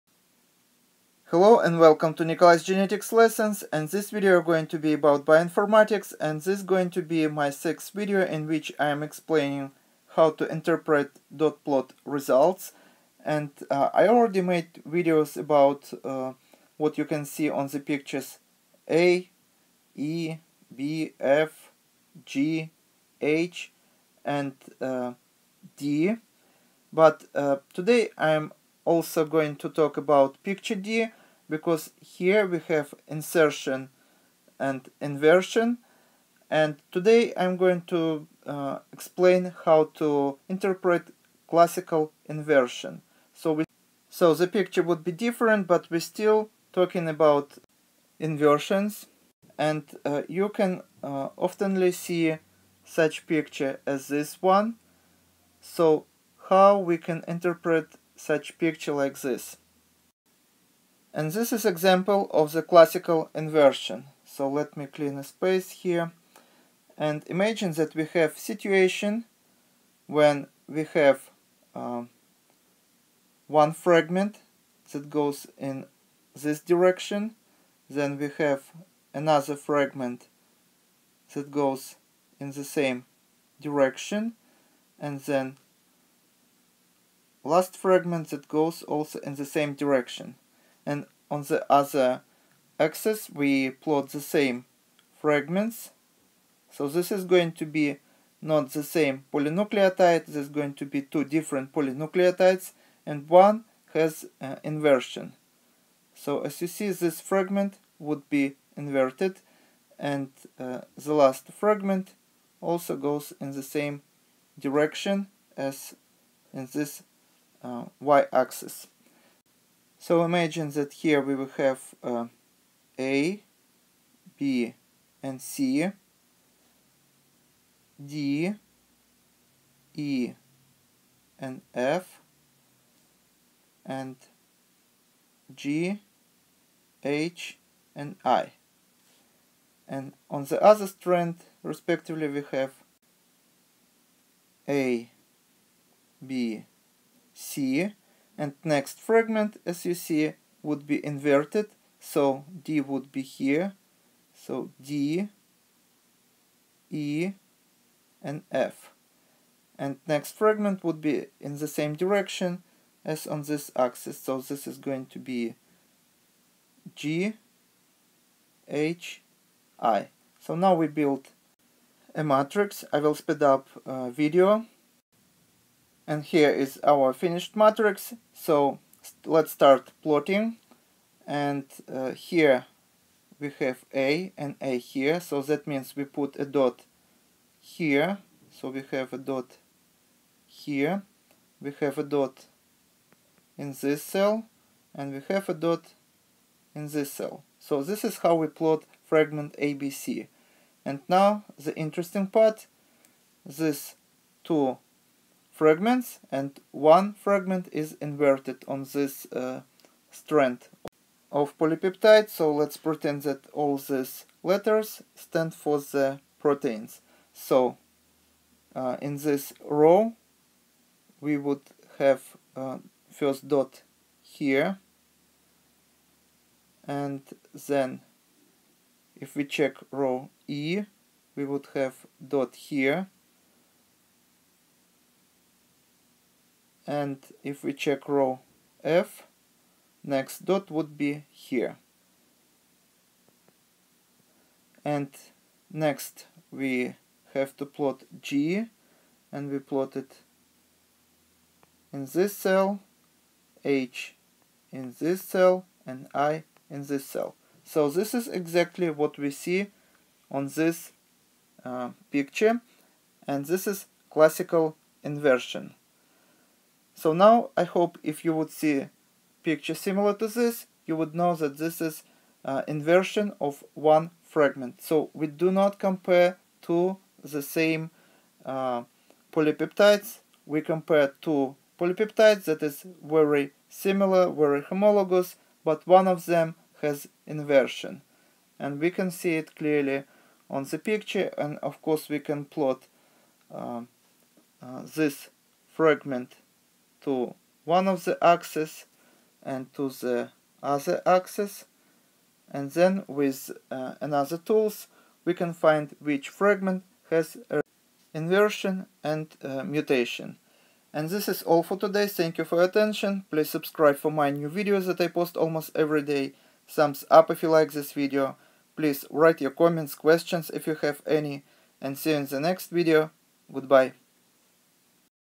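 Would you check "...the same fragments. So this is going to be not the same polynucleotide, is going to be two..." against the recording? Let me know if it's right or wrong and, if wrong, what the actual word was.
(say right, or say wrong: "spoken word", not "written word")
right.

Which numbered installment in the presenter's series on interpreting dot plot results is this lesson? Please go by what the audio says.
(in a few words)
sixth.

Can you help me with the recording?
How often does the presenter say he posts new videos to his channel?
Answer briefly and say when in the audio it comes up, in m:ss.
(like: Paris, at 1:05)
almost every day, at 5:15.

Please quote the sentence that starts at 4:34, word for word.
So we do not compare two the same uh, polypeptides.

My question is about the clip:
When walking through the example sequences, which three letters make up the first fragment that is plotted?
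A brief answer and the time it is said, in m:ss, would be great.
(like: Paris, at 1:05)
A, B, C, at 2:02.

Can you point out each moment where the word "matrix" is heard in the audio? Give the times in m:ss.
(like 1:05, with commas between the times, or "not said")
2:52, 2:57.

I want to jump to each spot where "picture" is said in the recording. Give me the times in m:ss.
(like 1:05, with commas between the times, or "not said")
0:17, 0:30, 0:44, 0:53, 0:58, 4:22, 4:29, 4:50.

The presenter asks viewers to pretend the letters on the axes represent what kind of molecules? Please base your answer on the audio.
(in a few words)
proteins.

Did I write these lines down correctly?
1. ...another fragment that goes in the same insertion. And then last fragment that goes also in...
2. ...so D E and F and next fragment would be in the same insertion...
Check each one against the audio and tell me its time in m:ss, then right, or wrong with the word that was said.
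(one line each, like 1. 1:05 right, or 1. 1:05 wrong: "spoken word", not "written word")
1. 1:19 wrong: "direction", not "insertion"
2. 2:34 wrong: "direction", not "insertion".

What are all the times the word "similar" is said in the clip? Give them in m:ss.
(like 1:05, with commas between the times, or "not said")
4:29, 4:43.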